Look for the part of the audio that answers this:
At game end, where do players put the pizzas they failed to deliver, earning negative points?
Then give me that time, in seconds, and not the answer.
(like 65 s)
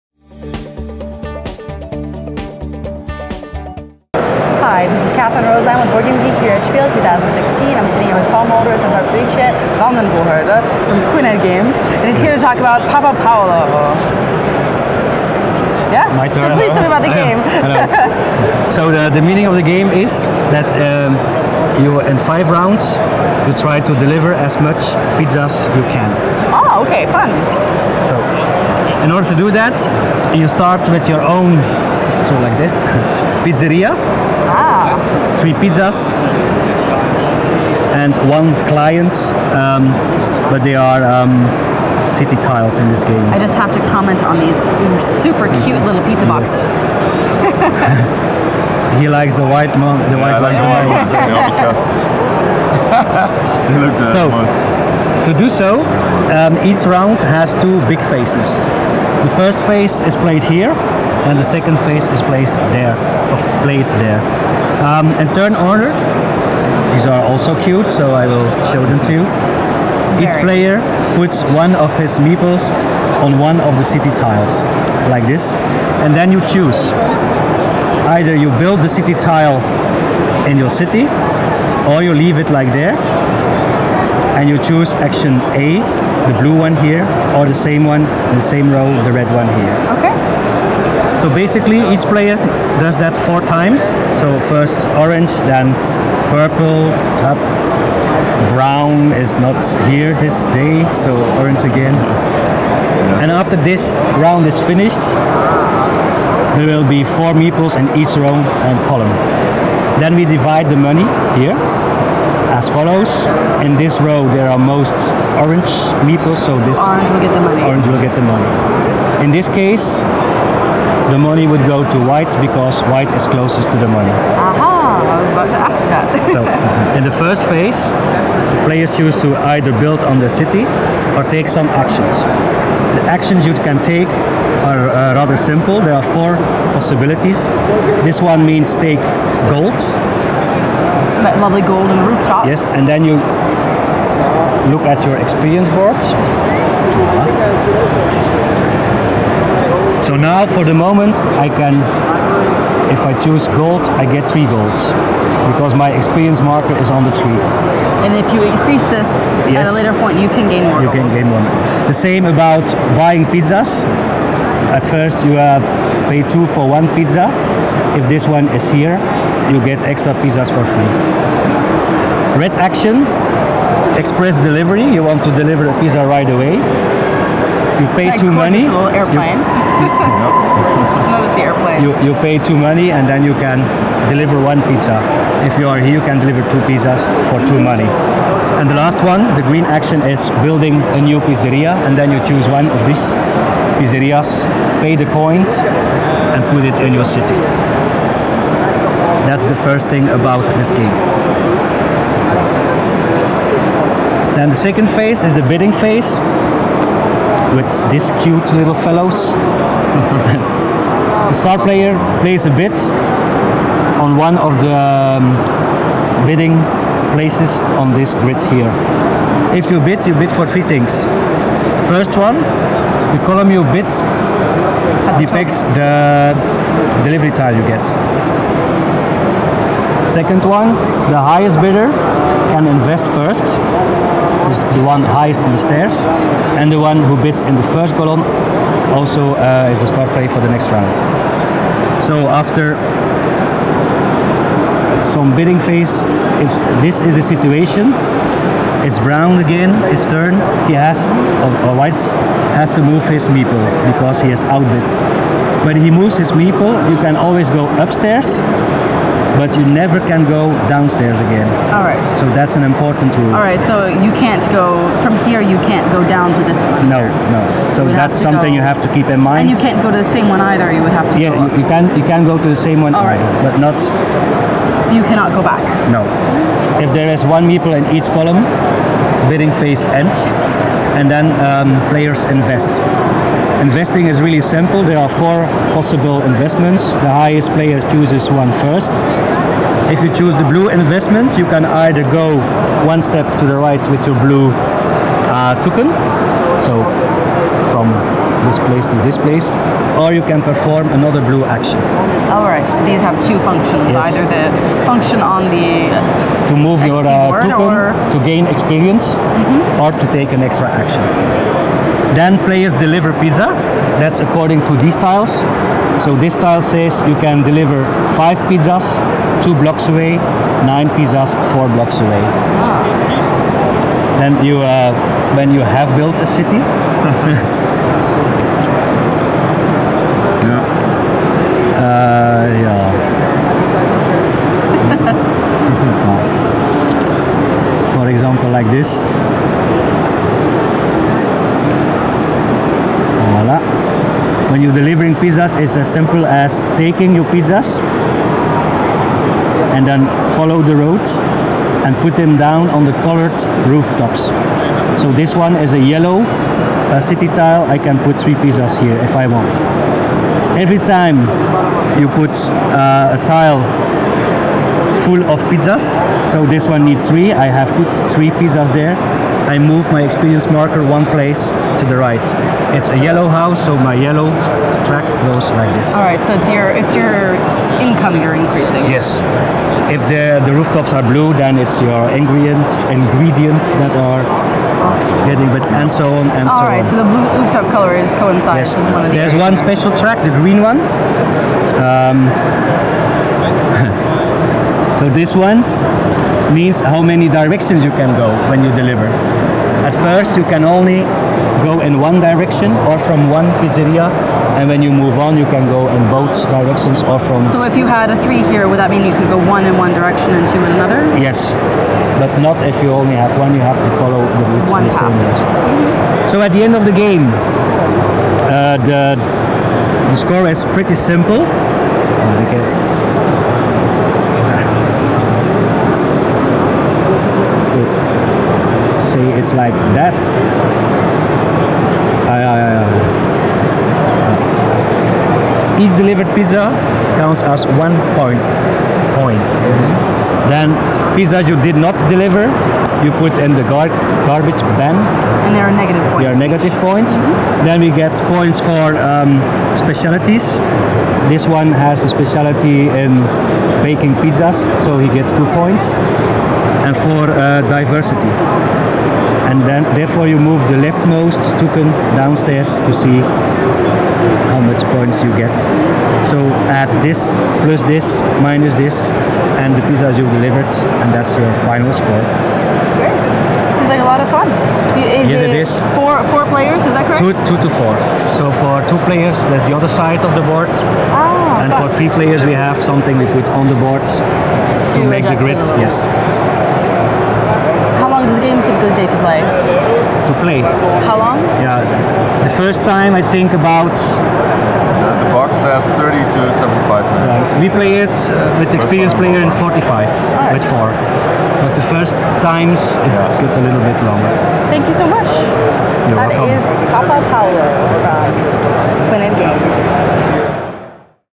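444 s.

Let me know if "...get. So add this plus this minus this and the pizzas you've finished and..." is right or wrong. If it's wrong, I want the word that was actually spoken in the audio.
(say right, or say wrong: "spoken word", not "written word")
wrong: "delivered", not "finished".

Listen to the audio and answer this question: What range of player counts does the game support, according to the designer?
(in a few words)
2 to 4.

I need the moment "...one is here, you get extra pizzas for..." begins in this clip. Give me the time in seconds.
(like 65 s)
168 s.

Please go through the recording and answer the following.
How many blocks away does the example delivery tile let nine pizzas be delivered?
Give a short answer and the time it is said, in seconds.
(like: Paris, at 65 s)
4, at 321 s.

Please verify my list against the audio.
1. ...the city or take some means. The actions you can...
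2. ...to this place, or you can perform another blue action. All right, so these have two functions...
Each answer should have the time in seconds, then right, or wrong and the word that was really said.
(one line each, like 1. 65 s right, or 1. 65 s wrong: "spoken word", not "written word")
1. 130 s wrong: "actions", not "means"
2. 298 s right.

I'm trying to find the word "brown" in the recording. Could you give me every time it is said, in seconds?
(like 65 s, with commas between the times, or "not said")
98 s, 248 s.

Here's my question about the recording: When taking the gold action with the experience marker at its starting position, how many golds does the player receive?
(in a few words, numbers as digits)
3.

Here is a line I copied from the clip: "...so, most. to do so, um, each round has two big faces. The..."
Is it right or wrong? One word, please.
right.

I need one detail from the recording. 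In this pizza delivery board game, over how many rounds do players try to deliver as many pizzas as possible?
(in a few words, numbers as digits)
5.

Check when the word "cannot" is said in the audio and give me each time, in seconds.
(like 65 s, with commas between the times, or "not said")
275 s.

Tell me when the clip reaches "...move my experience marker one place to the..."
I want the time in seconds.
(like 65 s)
369 s.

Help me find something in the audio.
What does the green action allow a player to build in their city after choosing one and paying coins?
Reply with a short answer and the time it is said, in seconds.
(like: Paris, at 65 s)
A new pizzeria, at 190 s.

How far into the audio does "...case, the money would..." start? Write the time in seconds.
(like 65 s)
119 s.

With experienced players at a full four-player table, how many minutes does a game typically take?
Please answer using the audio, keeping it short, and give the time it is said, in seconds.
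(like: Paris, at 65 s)
45, at 499 s.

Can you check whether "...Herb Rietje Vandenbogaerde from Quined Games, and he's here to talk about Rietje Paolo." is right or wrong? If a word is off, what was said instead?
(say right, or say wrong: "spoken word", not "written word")
wrong: "Papà", not "Rietje".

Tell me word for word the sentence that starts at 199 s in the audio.
That's the first thing about this game.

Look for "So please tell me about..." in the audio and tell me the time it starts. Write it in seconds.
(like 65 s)
16 s.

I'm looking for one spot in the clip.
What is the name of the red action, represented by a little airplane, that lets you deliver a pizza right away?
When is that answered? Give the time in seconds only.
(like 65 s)
173 s.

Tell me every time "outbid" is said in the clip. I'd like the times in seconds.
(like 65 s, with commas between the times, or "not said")
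254 s.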